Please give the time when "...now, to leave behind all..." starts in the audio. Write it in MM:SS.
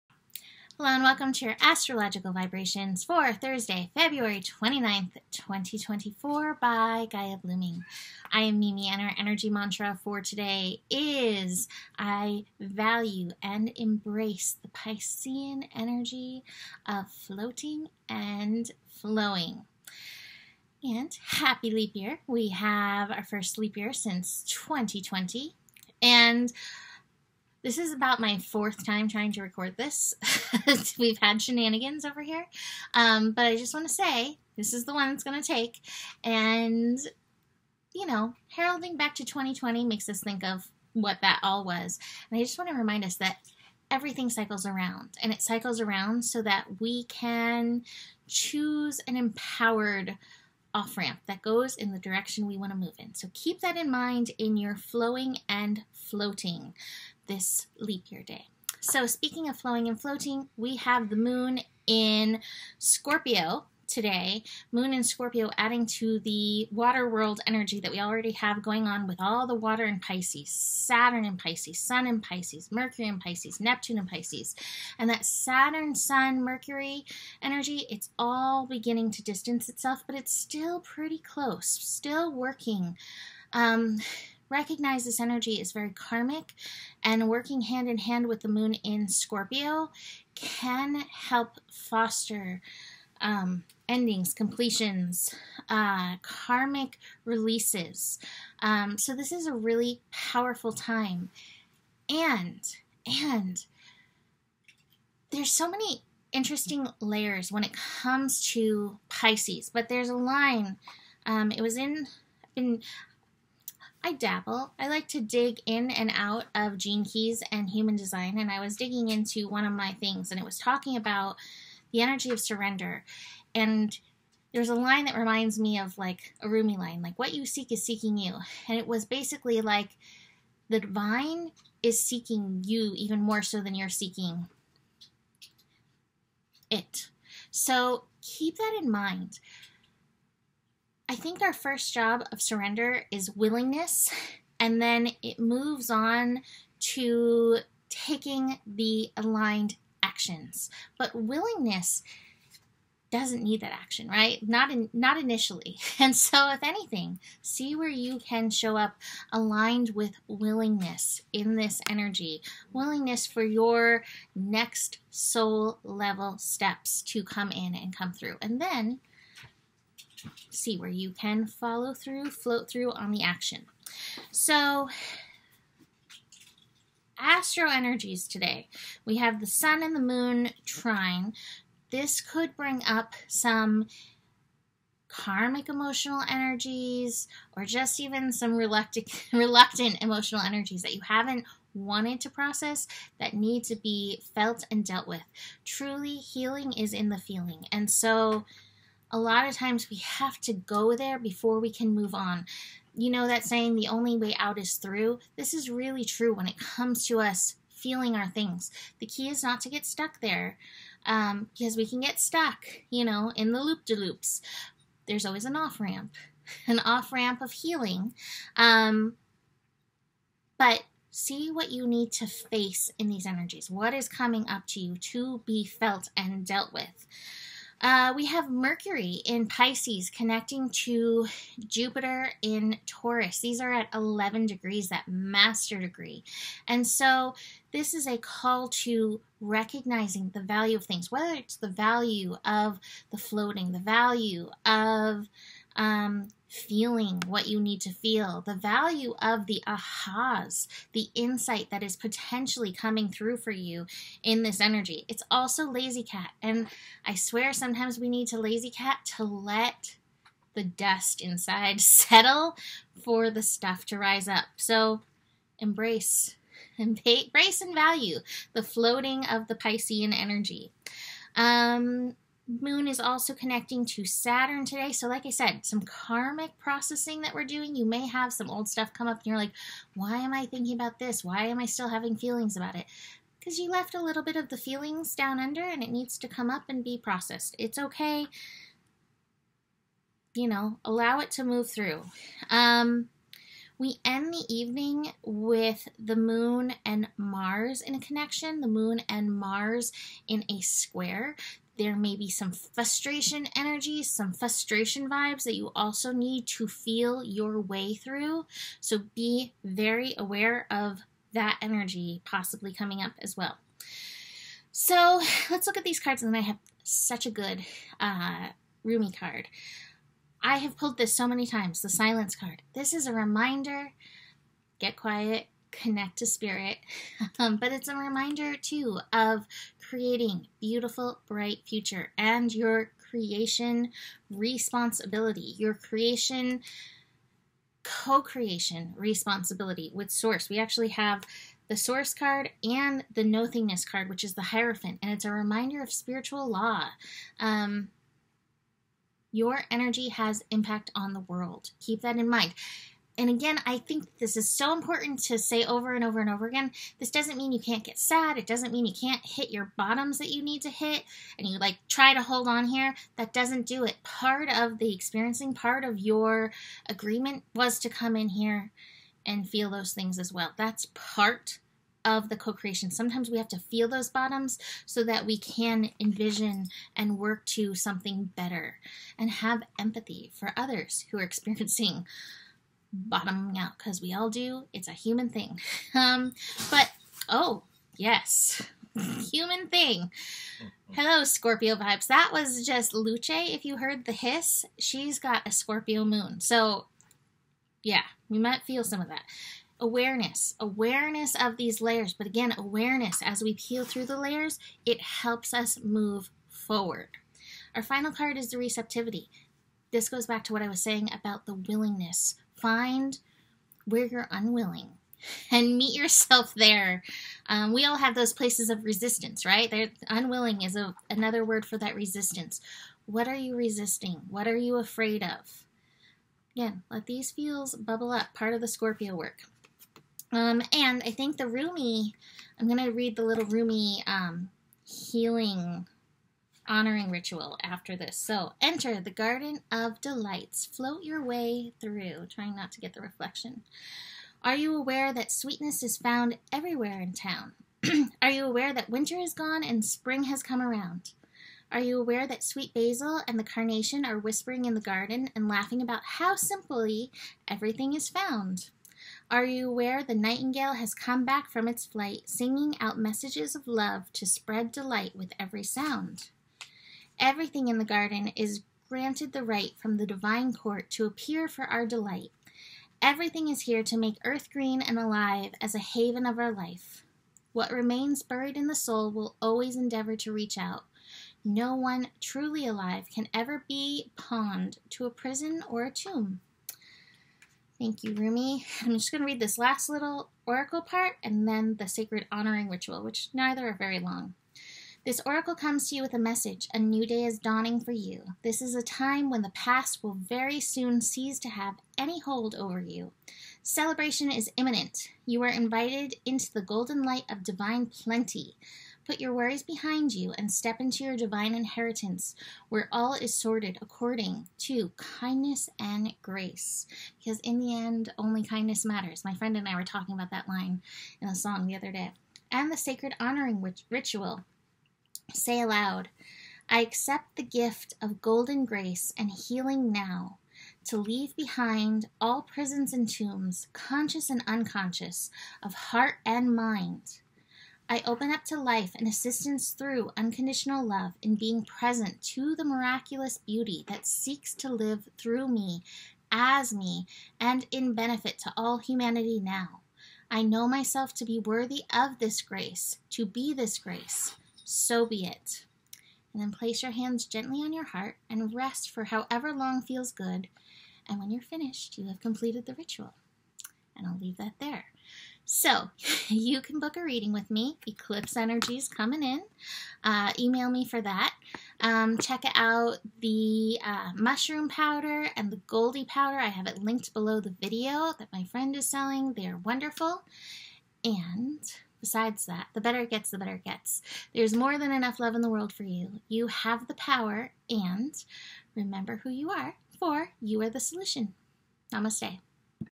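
08:49.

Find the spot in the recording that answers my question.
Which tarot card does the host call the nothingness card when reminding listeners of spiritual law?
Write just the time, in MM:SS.
05:44.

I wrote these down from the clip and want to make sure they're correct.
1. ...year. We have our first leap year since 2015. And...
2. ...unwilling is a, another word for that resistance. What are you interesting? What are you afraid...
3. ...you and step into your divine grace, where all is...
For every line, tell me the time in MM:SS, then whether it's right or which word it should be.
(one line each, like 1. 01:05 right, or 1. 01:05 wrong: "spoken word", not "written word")
1. 00:21 wrong: "2020", not "2015"
2. 07:00 wrong: "resisting", not "interesting"
3. 08:30 wrong: "inheritance", not "grace".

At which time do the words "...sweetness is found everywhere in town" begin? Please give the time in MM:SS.
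07:25.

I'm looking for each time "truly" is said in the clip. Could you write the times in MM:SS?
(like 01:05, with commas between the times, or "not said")
03:15, 08:02.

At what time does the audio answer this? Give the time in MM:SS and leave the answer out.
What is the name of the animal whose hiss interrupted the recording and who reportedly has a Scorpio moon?
06:32.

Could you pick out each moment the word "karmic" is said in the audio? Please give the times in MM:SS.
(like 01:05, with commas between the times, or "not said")
01:25, 01:36, 03:05, 04:35.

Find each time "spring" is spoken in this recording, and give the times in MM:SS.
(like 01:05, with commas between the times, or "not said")
07:29.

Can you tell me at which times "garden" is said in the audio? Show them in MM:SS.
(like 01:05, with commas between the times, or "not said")
07:19, 07:34, 07:47.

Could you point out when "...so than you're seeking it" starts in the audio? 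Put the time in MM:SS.
02:13.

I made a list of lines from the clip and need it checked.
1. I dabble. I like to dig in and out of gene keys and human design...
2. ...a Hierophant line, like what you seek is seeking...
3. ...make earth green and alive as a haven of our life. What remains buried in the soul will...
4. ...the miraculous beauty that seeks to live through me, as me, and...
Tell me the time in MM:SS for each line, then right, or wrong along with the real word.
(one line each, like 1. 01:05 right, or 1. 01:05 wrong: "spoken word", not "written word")
1. 01:54 right
2. 02:06 wrong: "Rumi", not "Hierophant"
3. 07:53 right
4. 09:02 right.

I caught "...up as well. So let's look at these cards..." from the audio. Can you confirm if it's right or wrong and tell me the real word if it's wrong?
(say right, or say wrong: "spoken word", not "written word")
right.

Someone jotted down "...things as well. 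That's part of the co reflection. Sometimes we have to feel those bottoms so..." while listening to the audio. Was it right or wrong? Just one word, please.
wrong.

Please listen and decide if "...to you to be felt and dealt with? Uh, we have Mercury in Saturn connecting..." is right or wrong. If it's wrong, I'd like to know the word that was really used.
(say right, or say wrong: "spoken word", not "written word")
wrong: "Pisces", not "Saturn".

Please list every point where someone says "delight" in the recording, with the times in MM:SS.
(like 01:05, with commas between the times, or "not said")
07:20, 07:44, 07:51.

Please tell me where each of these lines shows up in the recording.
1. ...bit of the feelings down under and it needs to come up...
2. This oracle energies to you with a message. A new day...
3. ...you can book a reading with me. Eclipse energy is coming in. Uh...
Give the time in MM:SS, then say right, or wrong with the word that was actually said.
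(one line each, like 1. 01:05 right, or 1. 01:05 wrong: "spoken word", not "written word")
1. 04:44 right
2. 08:15 wrong: "comes", not "energies"
3. 09:26 right.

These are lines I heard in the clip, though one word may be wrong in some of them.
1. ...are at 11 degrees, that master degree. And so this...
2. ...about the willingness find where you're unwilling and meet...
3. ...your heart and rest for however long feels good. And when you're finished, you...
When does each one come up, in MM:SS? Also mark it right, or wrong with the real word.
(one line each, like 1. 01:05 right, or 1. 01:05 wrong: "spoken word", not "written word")
1. 03:53 right
2. 06:51 right
3. 09:17 right.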